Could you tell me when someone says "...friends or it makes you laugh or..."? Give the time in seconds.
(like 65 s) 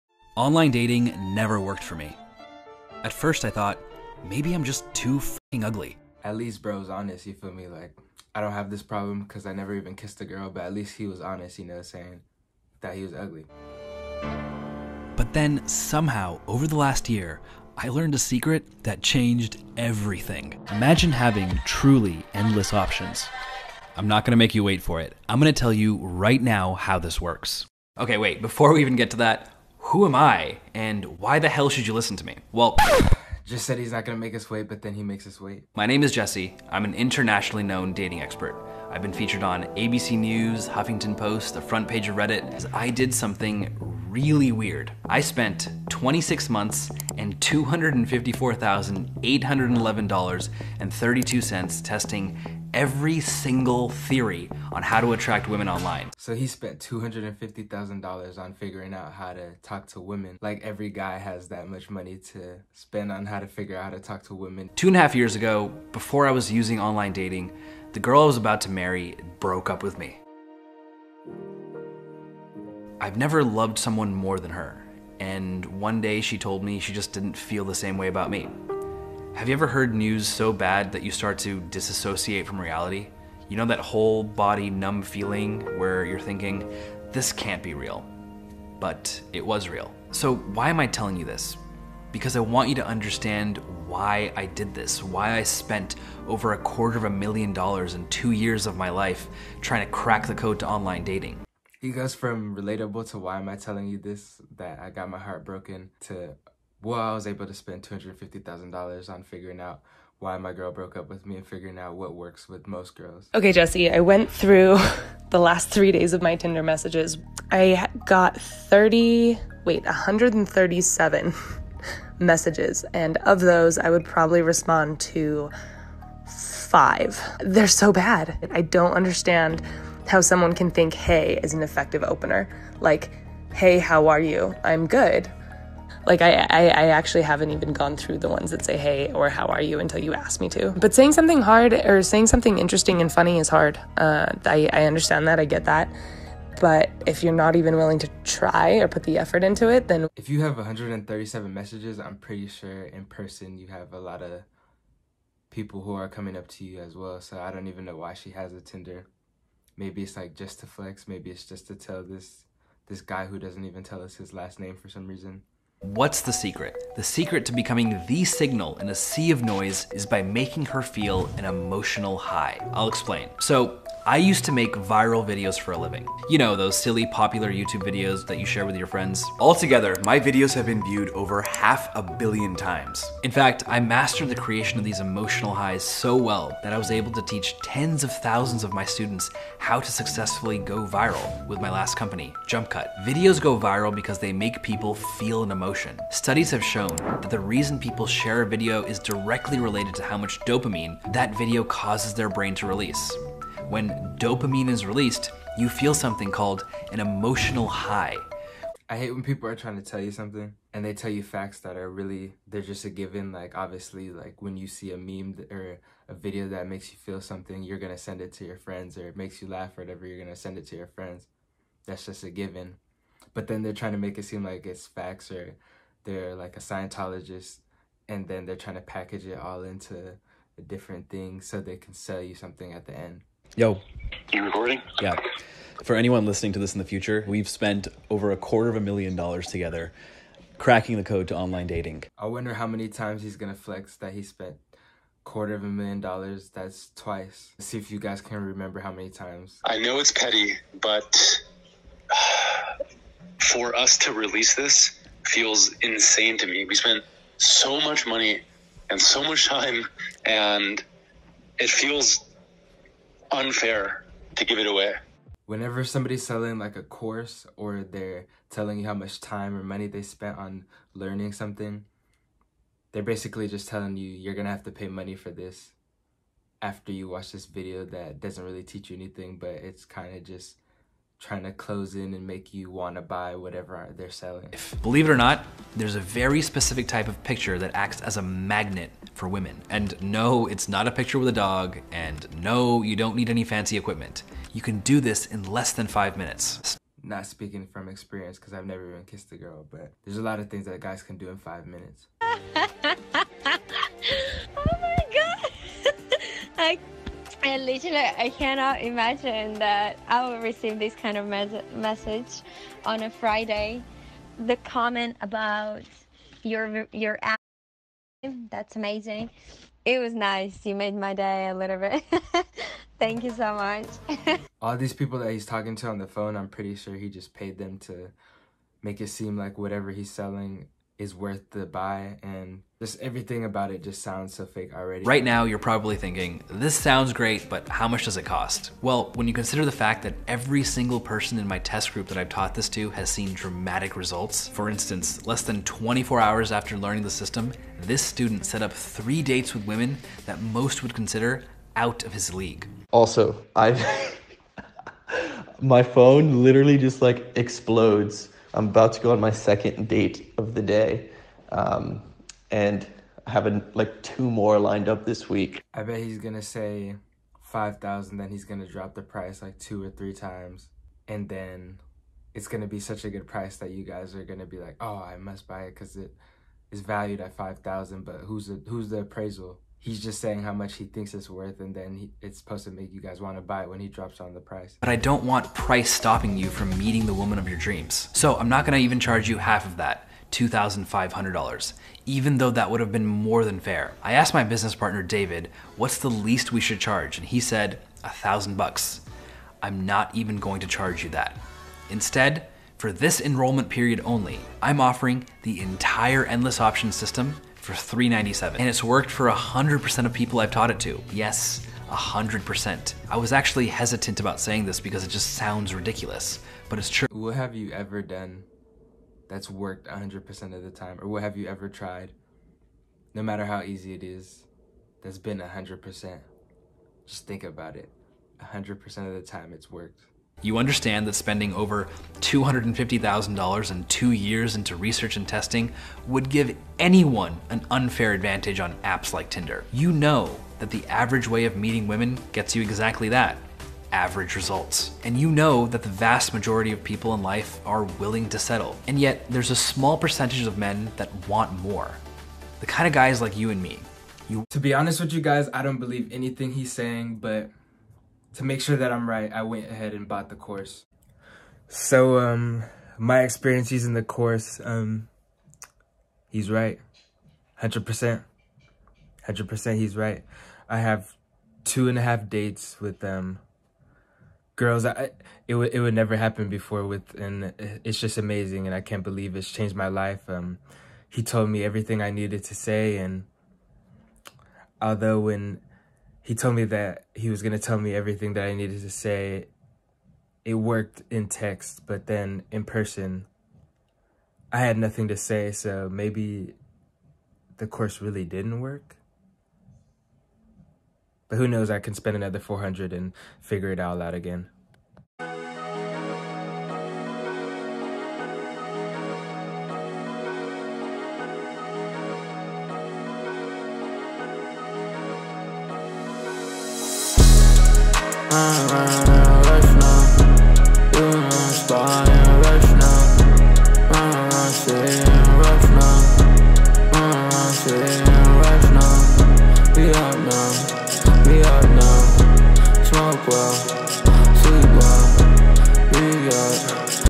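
218 s.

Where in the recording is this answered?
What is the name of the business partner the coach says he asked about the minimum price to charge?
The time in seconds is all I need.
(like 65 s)
395 s.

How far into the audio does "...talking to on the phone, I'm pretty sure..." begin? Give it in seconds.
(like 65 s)
325 s.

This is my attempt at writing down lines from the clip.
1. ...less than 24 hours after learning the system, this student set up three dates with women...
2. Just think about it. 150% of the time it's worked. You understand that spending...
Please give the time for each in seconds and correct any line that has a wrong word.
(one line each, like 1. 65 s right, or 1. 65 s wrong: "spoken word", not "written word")
1. 345 s right
2. 427 s wrong: "100", not "150".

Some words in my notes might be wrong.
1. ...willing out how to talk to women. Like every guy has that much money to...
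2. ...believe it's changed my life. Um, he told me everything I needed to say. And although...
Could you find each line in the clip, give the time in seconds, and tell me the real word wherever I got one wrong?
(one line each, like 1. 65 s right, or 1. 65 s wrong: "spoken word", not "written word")
1. 58 s wrong: "figuring", not "willing"
2. 479 s right.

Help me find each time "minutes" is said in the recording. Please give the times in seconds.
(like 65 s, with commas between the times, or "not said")
296 s, 301 s.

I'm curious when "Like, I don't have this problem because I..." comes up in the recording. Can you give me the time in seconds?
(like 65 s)
7 s.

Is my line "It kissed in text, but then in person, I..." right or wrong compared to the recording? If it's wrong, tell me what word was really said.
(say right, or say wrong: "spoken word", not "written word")
wrong: "worked", not "kissed".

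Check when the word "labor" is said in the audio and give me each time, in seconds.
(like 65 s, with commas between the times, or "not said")
not said.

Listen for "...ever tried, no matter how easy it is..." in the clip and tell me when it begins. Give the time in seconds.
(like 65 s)
421 s.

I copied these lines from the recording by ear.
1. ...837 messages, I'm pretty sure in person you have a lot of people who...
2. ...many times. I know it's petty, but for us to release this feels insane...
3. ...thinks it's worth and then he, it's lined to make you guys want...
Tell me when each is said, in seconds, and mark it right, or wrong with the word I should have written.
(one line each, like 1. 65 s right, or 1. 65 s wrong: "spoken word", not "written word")
1. 150 s wrong: "137", not "837"
2. 248 s right
3. 380 s wrong: "supposed", not "lined".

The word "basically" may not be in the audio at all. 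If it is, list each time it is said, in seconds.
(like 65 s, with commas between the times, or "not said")
273 s.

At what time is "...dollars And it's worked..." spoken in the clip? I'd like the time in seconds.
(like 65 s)
408 s.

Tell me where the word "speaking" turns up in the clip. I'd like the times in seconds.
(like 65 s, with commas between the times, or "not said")
297 s.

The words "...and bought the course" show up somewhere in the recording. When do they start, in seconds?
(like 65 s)
459 s.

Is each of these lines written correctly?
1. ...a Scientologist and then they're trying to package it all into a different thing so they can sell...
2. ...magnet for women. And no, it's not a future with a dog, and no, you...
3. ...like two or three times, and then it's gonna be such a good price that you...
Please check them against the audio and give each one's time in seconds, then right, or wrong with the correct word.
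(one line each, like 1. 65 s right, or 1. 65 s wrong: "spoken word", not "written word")
1. 226 s right
2. 288 s wrong: "picture", not "future"
3. 369 s right.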